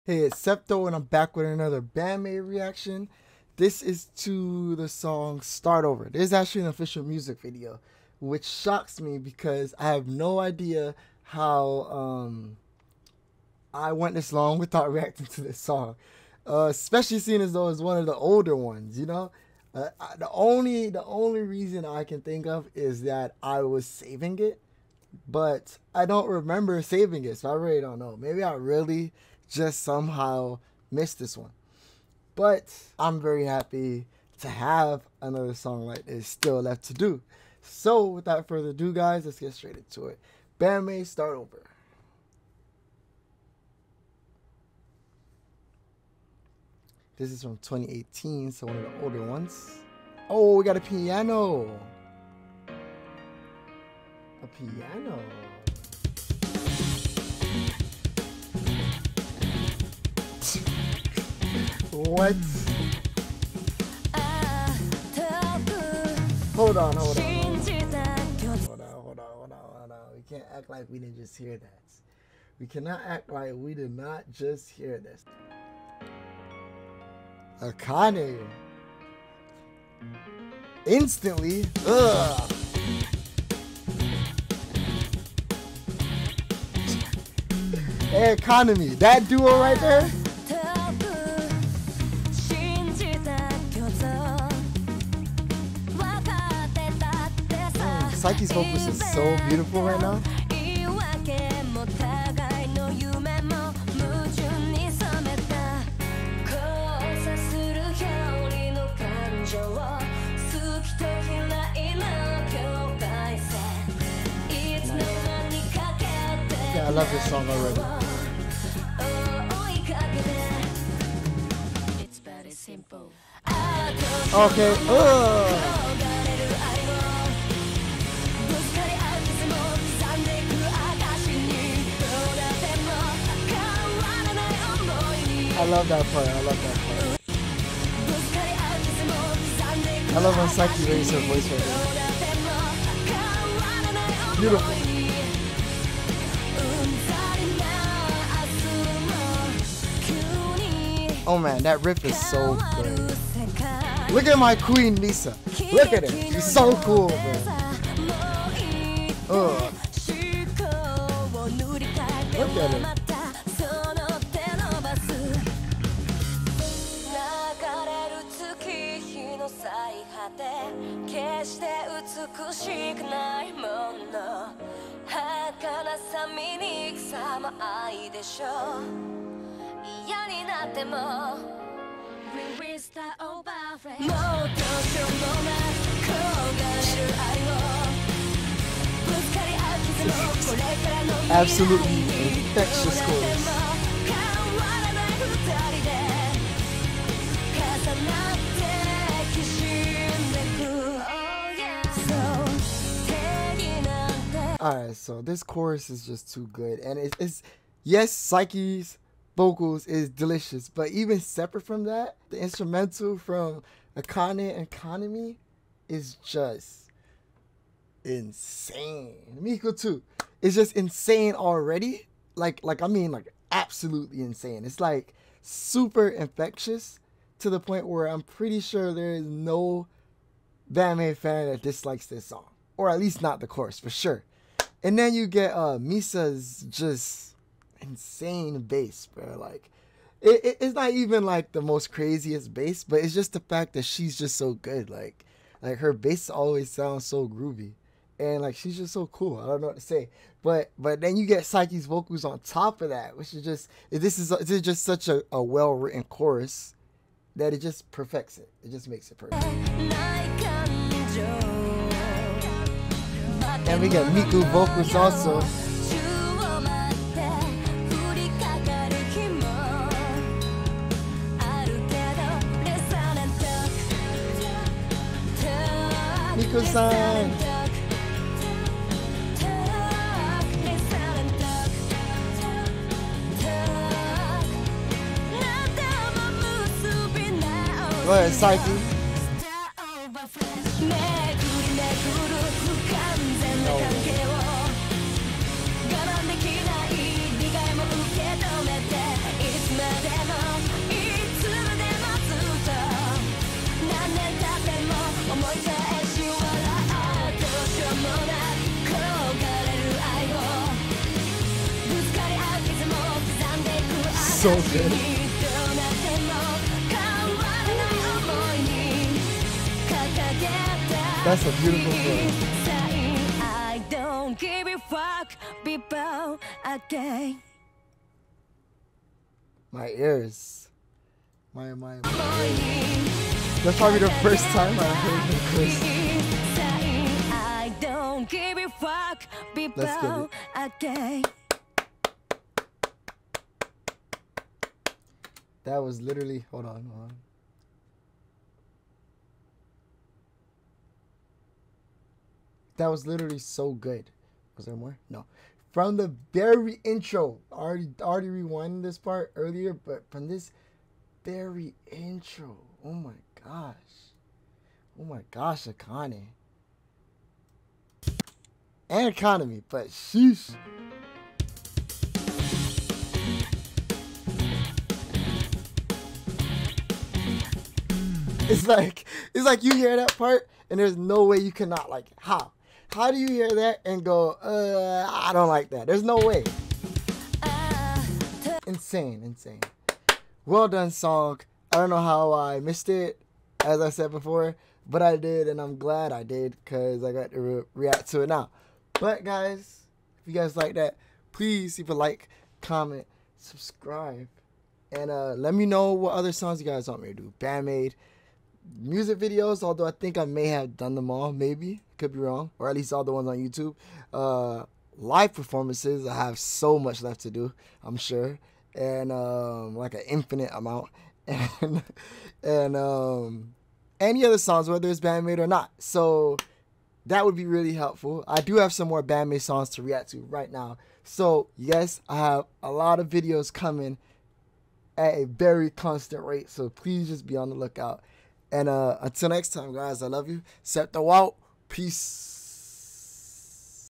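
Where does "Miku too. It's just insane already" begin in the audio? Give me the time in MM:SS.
03:39.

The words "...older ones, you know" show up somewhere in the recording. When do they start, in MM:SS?
00:18.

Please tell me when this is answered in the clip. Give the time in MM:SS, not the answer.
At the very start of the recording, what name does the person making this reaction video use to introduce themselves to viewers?
00:00.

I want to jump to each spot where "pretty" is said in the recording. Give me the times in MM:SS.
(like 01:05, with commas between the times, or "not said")
03:48.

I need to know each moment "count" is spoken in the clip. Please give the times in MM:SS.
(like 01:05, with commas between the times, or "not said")
not said.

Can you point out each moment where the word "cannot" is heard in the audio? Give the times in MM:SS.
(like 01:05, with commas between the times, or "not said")
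01:12, 06:21.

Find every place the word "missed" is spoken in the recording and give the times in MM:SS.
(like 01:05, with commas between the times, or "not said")
00:30, 06:32.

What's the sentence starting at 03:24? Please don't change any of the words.
so this chorus is just too good.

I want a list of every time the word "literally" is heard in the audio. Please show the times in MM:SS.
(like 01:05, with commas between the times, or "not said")
05:46, 05:53.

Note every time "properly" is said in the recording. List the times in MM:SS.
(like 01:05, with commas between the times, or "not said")
not said.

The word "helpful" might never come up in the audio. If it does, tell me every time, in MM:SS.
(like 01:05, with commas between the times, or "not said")
07:07.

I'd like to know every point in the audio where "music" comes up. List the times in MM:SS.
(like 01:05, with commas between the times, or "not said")
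00:07, 06:48.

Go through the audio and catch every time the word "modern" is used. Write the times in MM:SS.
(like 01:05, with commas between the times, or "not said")
not said.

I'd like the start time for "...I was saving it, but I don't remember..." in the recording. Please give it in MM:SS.
00:23.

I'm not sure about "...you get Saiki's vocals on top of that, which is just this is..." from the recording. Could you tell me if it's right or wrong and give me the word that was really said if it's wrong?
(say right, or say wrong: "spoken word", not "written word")
right.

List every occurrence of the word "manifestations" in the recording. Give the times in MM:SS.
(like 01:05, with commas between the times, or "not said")
not said.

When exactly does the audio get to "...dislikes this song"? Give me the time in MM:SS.
03:51.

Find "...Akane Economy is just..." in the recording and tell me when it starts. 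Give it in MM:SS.
03:33.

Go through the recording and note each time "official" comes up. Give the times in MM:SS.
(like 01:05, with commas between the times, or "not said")
00:06.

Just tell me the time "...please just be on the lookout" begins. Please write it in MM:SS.
07:16.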